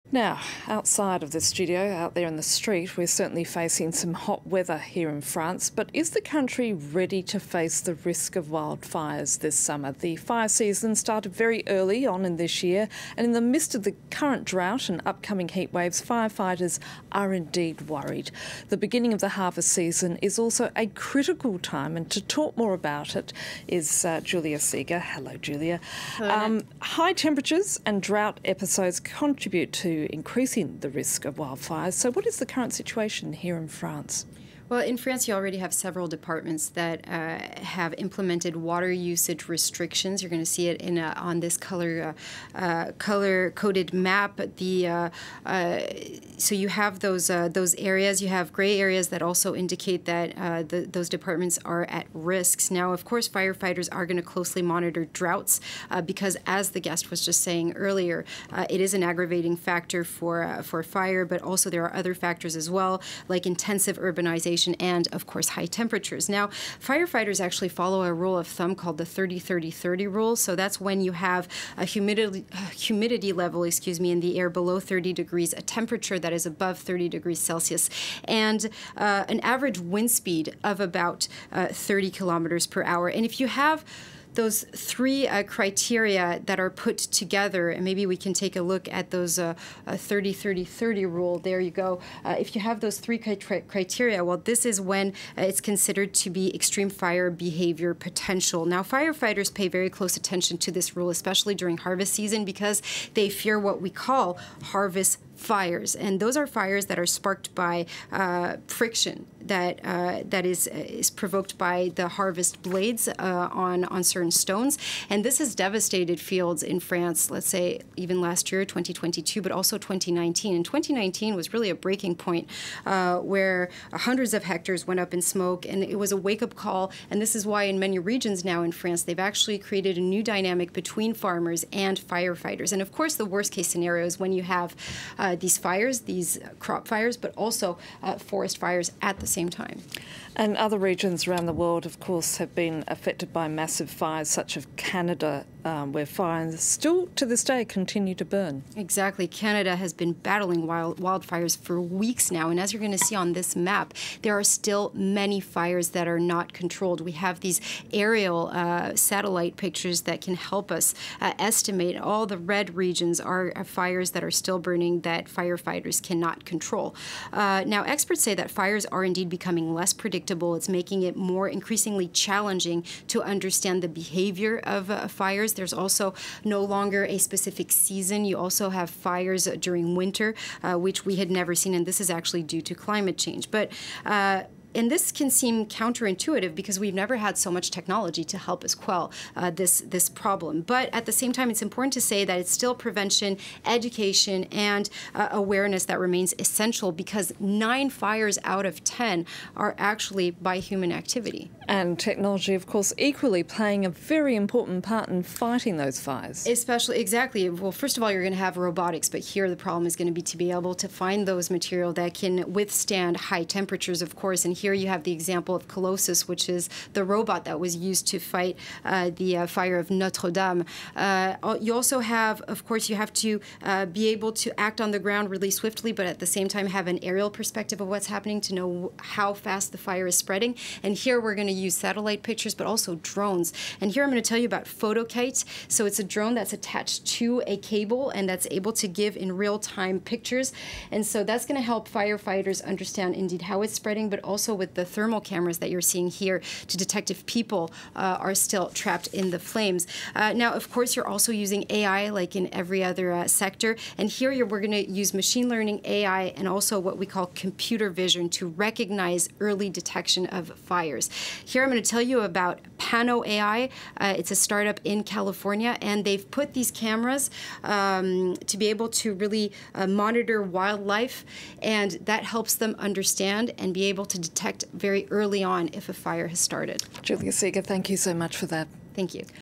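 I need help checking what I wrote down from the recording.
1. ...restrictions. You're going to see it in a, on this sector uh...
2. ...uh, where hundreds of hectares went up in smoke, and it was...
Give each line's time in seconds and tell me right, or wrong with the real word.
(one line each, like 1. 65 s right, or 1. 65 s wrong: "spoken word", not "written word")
1. 39 s wrong: "color", not "sector"
2. 122 s right.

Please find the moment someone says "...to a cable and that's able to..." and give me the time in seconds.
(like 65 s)
237 s.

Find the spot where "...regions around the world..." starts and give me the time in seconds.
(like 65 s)
140 s.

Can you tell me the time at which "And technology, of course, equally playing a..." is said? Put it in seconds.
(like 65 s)
201 s.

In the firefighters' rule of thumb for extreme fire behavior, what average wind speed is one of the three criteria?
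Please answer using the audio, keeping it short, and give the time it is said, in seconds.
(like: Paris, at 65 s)
30 km/h, at 81 s.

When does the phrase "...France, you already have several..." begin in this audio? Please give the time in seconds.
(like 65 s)
34 s.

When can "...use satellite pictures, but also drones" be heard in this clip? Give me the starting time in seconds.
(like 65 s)
231 s.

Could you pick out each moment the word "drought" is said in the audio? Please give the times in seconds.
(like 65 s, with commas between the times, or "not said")
14 s, 28 s, 55 s.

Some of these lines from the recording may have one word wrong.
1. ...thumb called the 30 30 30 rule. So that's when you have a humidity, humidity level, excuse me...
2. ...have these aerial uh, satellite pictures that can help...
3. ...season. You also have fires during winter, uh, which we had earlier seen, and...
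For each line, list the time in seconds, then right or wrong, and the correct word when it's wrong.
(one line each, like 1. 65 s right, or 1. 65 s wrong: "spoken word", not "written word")
1. 68 s right
2. 157 s right
3. 177 s wrong: "never", not "earlier".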